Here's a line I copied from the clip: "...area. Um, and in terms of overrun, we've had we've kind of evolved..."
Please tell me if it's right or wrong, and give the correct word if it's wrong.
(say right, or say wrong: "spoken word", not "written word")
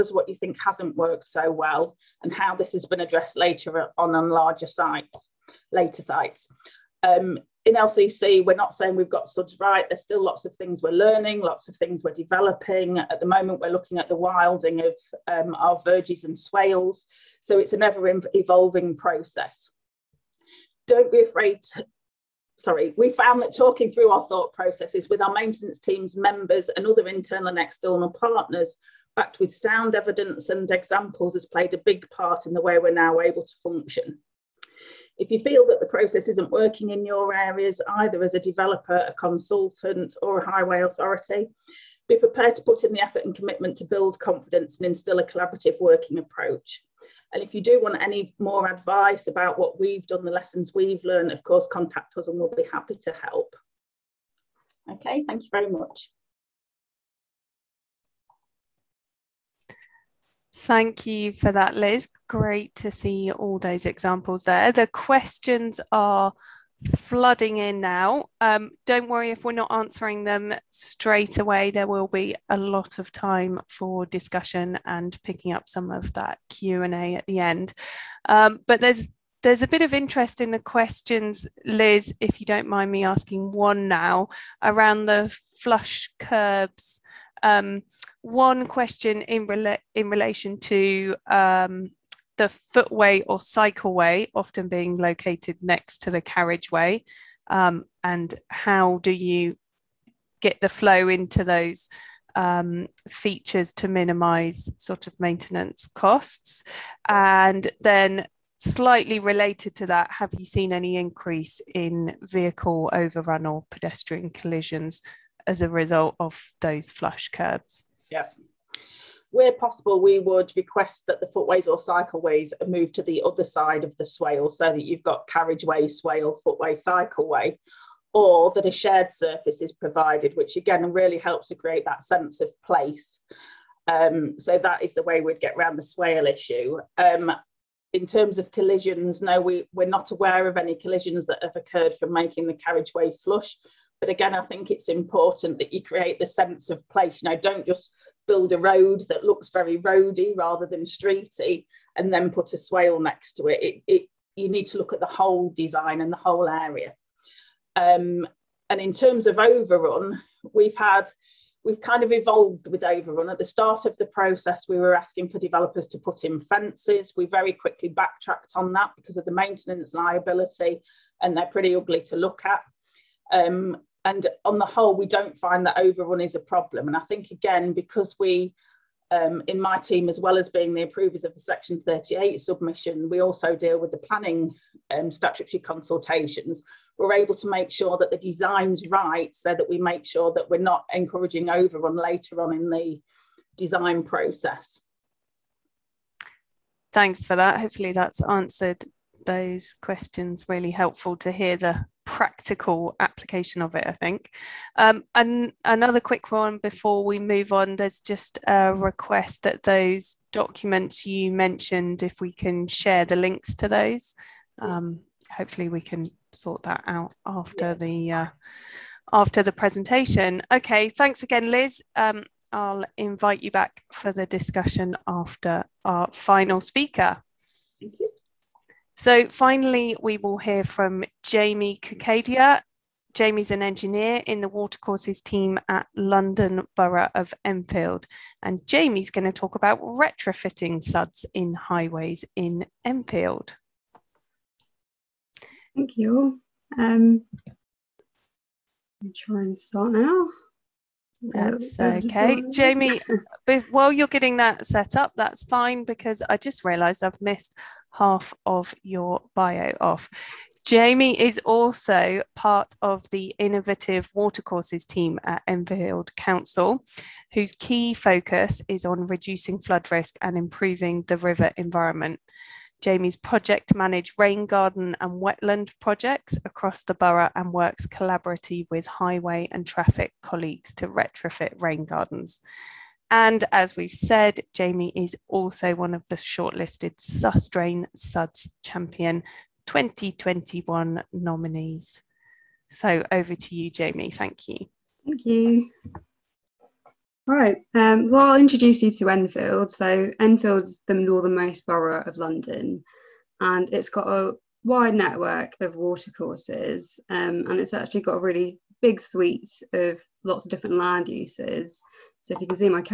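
right.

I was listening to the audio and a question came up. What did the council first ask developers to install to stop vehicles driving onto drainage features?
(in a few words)
Fences.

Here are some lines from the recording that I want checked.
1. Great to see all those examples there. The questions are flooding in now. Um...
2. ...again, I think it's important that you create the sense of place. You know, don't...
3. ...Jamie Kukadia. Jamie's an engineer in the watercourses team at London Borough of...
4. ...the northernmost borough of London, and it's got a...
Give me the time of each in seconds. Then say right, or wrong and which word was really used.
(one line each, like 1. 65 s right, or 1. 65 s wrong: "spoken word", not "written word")
1. 62 s right
2. 144 s right
3. 231 s right
4. 300 s right.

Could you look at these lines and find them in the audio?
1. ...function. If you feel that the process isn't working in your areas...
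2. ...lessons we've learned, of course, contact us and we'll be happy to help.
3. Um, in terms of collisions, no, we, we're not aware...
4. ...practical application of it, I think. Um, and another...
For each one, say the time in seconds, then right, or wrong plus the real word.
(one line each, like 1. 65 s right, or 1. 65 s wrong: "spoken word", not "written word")
1. 33 s right
2. 50 s right
3. 136 s right
4. 202 s right.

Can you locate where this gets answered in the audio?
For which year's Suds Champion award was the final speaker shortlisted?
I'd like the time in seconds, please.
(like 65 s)
289 s.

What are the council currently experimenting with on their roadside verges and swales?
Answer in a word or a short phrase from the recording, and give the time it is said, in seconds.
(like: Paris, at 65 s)
Wilding, at 14 s.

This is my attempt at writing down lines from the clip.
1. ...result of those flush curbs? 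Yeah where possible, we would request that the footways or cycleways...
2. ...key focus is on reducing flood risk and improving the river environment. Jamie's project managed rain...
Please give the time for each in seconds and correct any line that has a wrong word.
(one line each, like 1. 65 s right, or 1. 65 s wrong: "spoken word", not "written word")
1. 115 s right
2. 267 s right.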